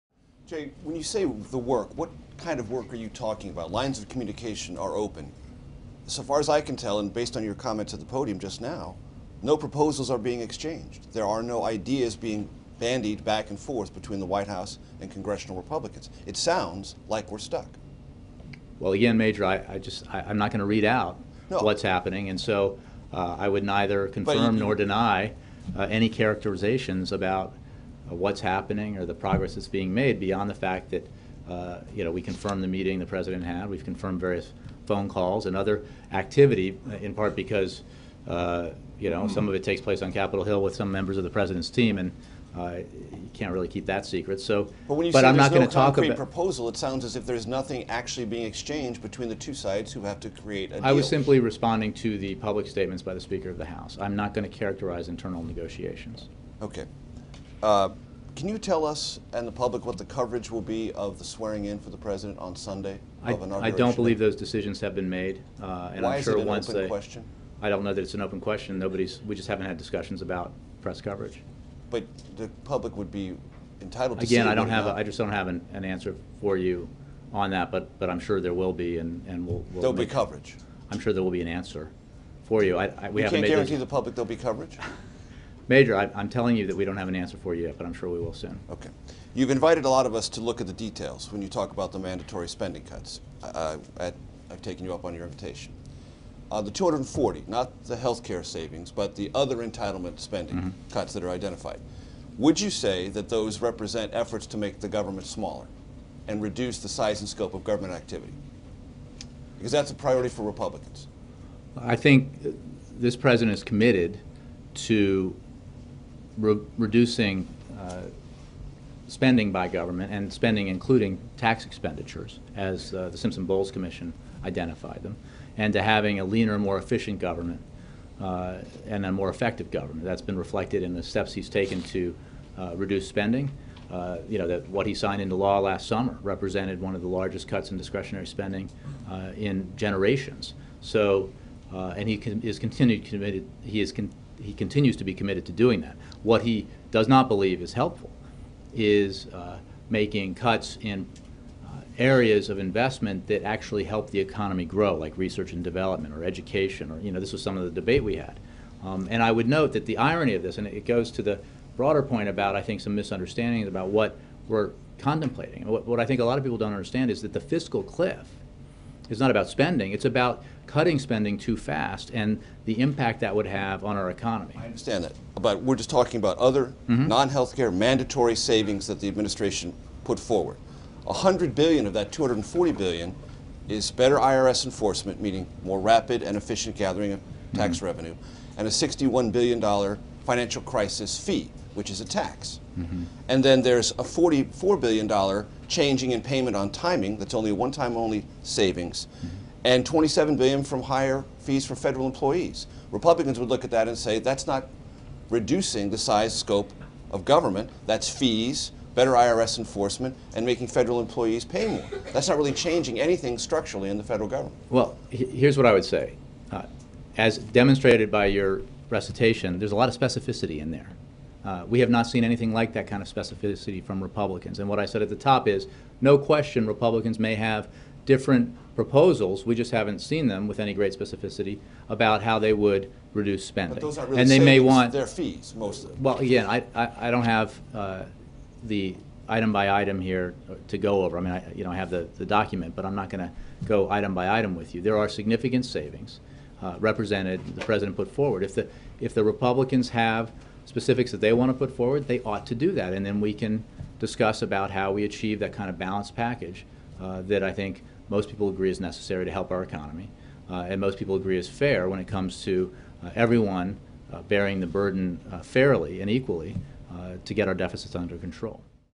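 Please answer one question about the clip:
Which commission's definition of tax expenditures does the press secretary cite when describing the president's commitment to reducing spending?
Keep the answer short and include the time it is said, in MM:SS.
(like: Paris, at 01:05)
Simpson-Bowles Commission, at 02:03.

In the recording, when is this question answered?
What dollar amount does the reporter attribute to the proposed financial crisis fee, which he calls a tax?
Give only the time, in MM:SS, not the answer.
03:08.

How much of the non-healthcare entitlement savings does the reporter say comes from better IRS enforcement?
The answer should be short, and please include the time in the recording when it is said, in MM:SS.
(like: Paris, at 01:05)
100 billion, at 03:01.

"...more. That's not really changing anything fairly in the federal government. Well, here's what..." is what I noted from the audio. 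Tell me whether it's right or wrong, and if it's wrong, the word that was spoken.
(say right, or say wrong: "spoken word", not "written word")
wrong: "structurally", not "fairly".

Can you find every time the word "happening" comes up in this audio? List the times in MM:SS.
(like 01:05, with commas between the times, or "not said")
00:21, 00:28.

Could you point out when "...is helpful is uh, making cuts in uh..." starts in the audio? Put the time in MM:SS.
02:27.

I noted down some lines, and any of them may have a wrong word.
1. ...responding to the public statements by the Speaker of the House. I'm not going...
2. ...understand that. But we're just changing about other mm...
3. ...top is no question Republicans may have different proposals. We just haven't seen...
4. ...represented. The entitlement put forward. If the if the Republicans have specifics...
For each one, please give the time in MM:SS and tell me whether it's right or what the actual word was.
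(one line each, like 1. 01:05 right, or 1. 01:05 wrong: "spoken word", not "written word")
1. 00:51 right
2. 02:54 wrong: "talking", not "changing"
3. 03:45 right
4. 04:06 wrong: "president", not "entitlement".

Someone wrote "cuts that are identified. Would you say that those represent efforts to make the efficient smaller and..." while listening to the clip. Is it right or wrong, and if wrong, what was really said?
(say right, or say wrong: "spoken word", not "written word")
wrong: "government", not "efficient".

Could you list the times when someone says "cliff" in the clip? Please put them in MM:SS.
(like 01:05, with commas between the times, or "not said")
02:47.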